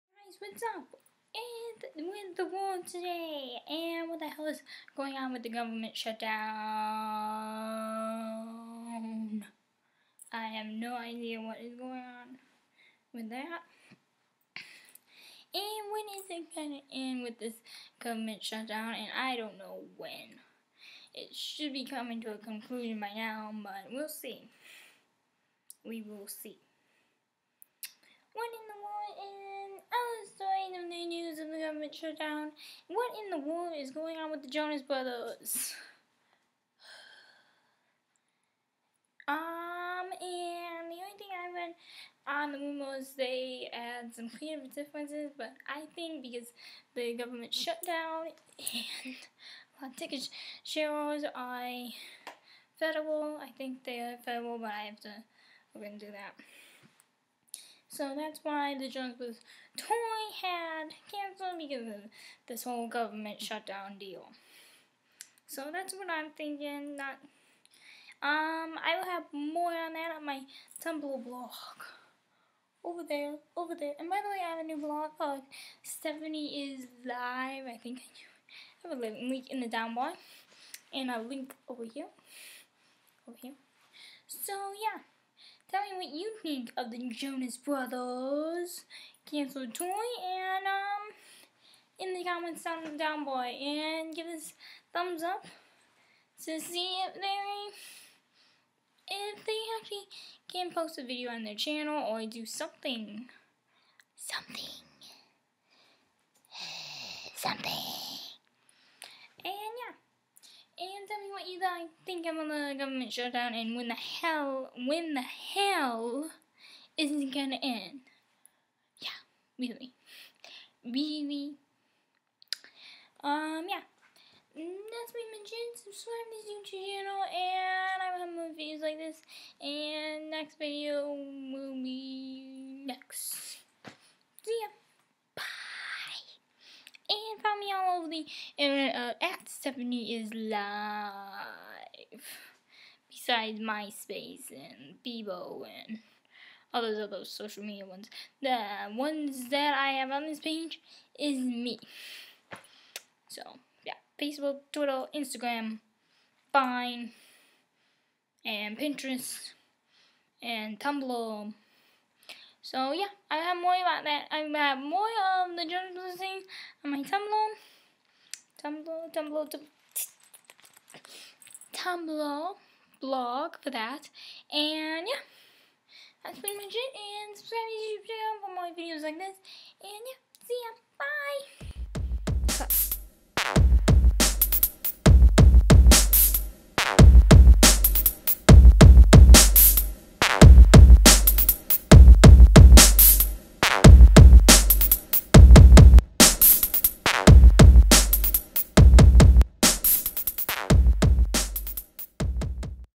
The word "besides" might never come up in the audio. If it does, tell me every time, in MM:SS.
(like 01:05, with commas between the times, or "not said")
02:23.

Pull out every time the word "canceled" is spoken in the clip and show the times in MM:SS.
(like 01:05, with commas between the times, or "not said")
01:01, 01:29.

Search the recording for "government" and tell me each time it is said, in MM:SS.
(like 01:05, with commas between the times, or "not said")
00:05, 00:17, 00:47, 01:02.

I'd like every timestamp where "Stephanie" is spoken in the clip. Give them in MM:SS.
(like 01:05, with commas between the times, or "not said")
01:15, 02:19.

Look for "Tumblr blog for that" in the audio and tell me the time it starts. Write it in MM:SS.
02:51.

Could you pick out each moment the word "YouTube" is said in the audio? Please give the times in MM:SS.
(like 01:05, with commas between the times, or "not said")
02:06, 02:57.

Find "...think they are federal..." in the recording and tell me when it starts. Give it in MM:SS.
00:53.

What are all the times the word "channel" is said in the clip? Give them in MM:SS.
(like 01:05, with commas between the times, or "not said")
01:41, 02:06, 02:58.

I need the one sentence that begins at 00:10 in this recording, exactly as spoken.
I have no idea what is going on with that.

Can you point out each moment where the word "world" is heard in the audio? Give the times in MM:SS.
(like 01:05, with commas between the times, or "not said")
00:02, 00:33.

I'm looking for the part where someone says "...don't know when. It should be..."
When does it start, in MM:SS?
00:19.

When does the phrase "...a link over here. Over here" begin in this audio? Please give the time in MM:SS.
01:21.